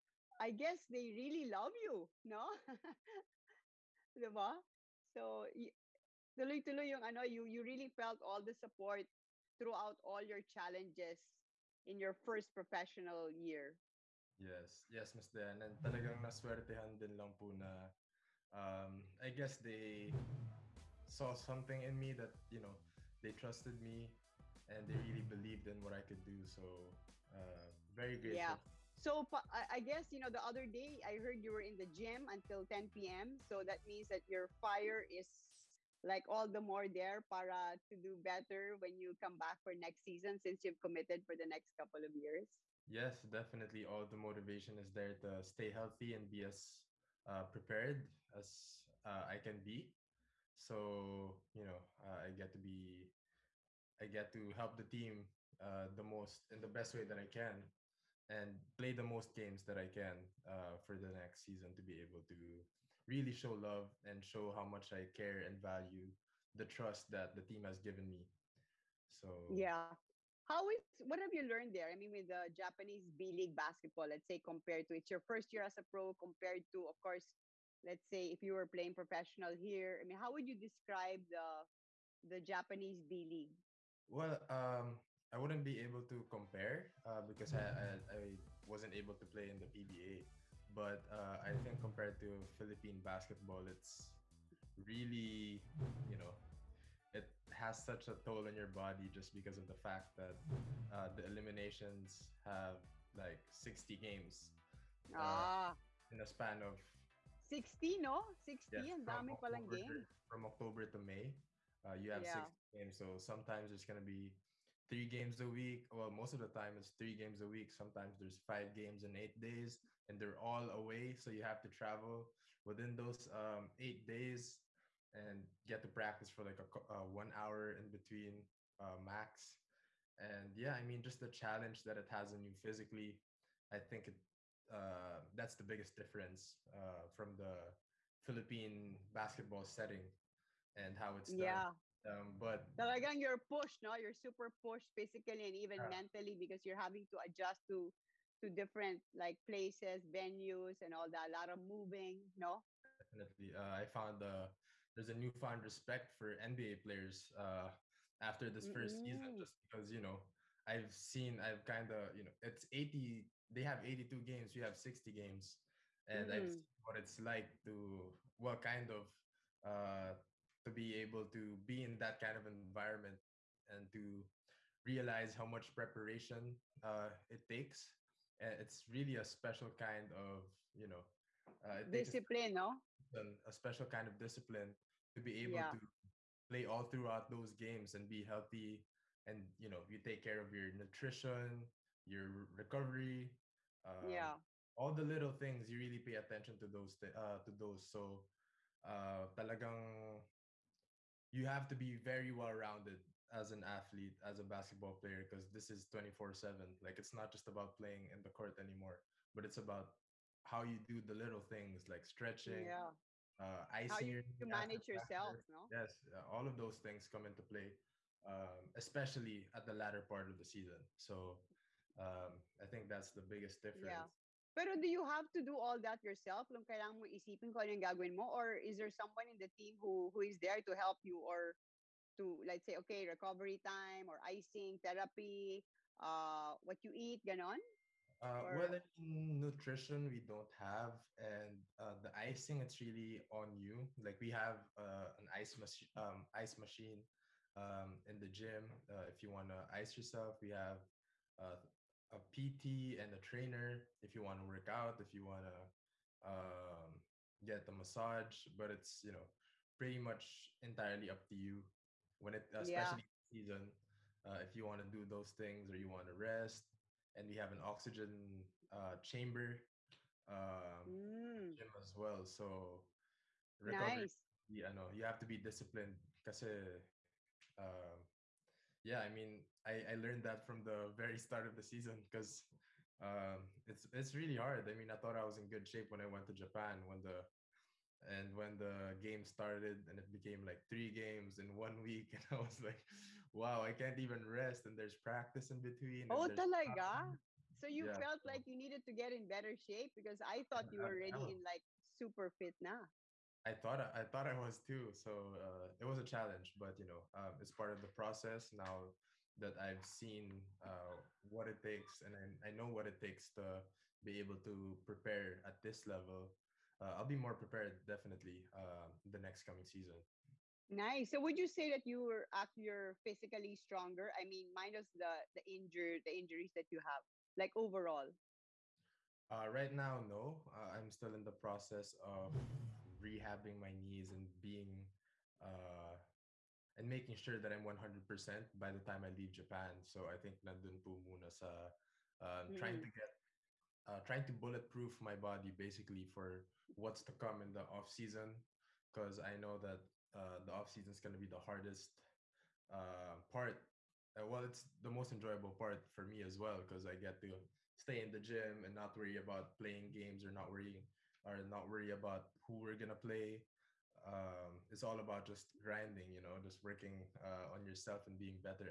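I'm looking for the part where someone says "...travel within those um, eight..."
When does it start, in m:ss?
2:01.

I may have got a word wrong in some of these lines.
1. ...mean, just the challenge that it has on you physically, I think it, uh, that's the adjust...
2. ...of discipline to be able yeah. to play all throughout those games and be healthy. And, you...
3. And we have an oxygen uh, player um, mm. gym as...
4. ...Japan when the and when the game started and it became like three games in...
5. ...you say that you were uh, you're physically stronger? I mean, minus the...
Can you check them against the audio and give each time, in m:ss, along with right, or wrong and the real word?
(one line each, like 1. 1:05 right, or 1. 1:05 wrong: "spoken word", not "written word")
1. 2:10 wrong: "biggest", not "adjust"
2. 3:04 right
3. 4:27 wrong: "chamber", not "player"
4. 4:46 right
5. 5:21 right.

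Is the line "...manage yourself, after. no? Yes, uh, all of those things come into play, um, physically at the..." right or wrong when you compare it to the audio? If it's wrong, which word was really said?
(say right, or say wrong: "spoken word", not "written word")
wrong: "especially", not "physically".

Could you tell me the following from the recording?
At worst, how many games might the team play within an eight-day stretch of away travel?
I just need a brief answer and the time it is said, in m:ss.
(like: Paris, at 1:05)
5 games, at 1:58.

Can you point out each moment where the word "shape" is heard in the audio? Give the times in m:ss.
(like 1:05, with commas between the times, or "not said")
4:45, 4:59.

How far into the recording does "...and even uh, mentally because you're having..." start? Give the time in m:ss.
2:25.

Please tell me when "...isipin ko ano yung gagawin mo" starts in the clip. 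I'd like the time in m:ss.
3:47.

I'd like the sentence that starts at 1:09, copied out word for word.
So yeah, how is what have you learned there?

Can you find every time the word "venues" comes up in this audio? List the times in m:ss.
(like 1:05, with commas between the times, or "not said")
2:30.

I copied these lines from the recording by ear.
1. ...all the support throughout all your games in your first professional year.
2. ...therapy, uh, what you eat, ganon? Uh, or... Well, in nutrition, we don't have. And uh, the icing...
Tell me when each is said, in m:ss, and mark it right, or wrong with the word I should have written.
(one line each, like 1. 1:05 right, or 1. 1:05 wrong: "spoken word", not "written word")
1. 0:08 wrong: "challenges", not "games"
2. 3:54 right.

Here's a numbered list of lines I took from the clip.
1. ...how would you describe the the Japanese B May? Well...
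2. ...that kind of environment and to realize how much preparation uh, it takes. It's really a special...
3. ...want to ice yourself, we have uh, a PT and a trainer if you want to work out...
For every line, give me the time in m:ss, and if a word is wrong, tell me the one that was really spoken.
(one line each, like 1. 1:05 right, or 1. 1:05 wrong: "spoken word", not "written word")
1. 1:20 wrong: "League", not "May"
2. 2:51 right
3. 4:09 right.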